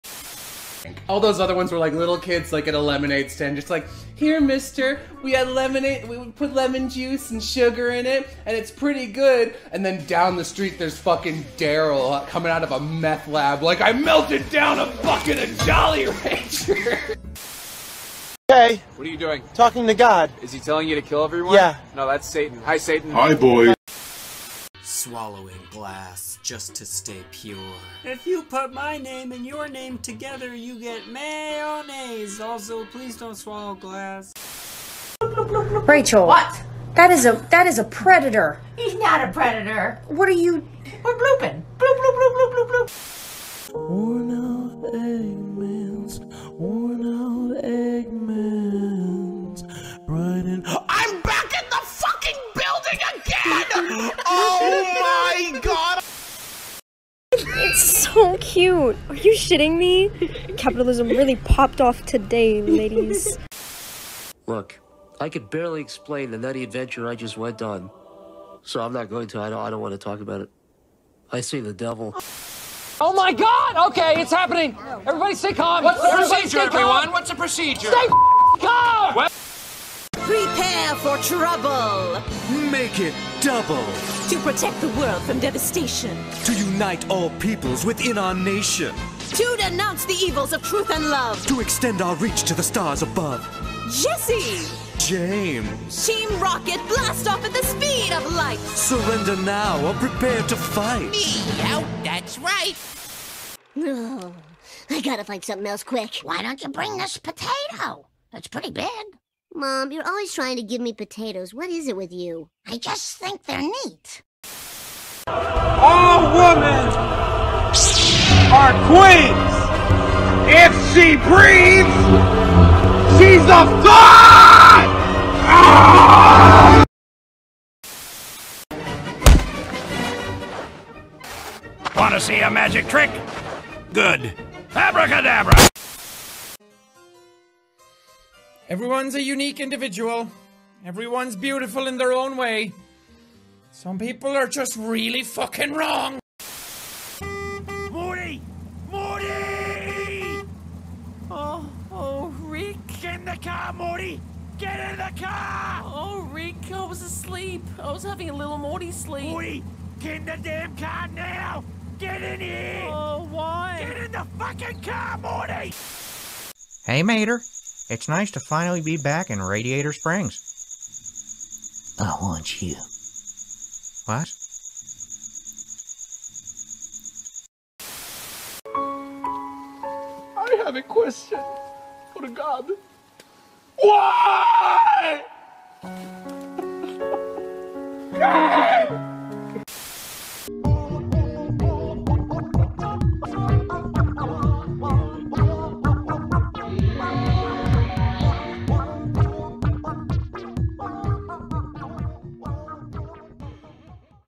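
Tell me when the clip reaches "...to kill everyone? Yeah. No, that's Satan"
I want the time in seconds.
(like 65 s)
20 s.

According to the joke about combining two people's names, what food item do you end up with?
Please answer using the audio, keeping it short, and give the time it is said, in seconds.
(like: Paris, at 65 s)
Mayonnaise, at 31 s.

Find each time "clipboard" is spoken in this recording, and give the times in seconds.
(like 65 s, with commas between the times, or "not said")
not said.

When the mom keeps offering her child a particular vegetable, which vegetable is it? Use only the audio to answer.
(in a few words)
Potato.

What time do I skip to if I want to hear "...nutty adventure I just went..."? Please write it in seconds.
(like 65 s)
66 s.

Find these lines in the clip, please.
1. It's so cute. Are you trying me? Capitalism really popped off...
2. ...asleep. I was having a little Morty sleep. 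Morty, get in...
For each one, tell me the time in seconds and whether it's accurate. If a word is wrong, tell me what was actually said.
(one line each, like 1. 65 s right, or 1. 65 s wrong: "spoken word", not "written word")
1. 57 s wrong: "shitting", not "trying"
2. 157 s right.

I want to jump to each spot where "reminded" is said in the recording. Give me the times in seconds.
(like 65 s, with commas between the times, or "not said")
not said.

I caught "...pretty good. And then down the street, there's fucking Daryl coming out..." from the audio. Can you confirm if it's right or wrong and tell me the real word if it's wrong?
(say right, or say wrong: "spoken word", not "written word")
right.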